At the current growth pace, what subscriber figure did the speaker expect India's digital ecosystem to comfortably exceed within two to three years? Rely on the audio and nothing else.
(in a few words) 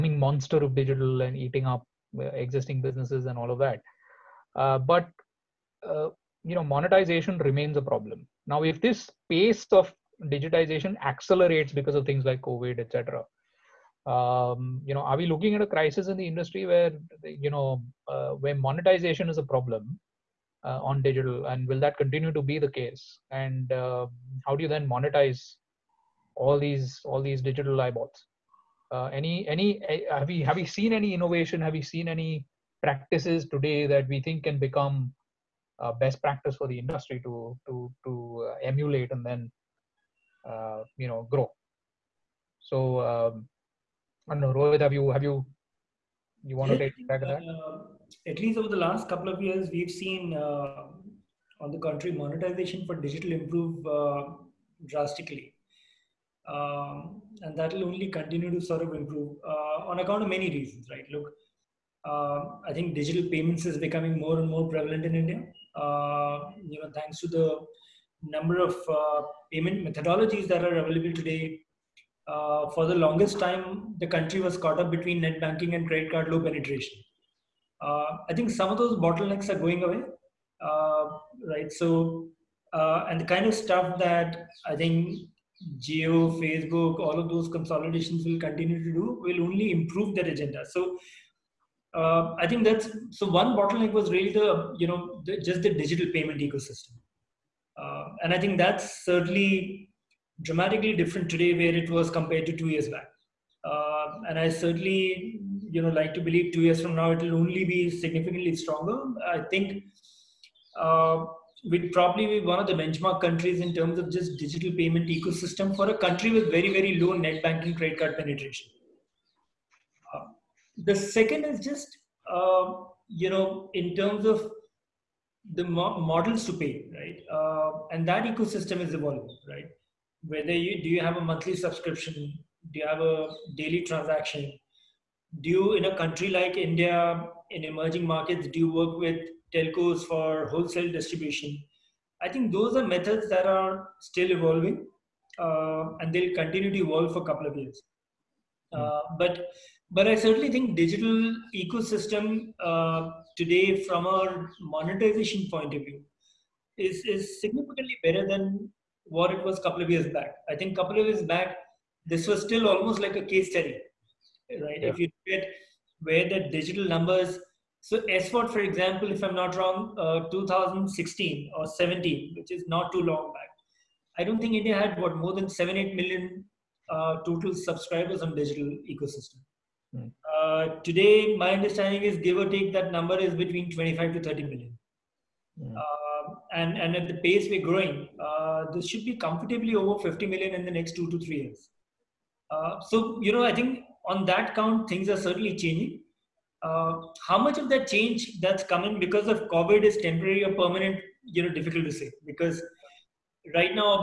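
50 million.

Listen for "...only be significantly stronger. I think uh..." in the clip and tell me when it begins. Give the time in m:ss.
1:47.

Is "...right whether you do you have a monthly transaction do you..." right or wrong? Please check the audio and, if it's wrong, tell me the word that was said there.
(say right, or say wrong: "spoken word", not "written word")
wrong: "subscription", not "transaction".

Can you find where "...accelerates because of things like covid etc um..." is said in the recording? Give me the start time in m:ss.
0:11.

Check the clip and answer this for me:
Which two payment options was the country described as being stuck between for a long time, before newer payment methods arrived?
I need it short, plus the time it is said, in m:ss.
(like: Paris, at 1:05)
Net banking and credit card, at 1:15.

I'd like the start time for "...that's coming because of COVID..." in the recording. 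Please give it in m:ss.
3:18.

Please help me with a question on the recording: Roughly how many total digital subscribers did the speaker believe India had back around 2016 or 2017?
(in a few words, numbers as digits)
7 to 8 million.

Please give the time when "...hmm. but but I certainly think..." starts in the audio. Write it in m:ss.
2:29.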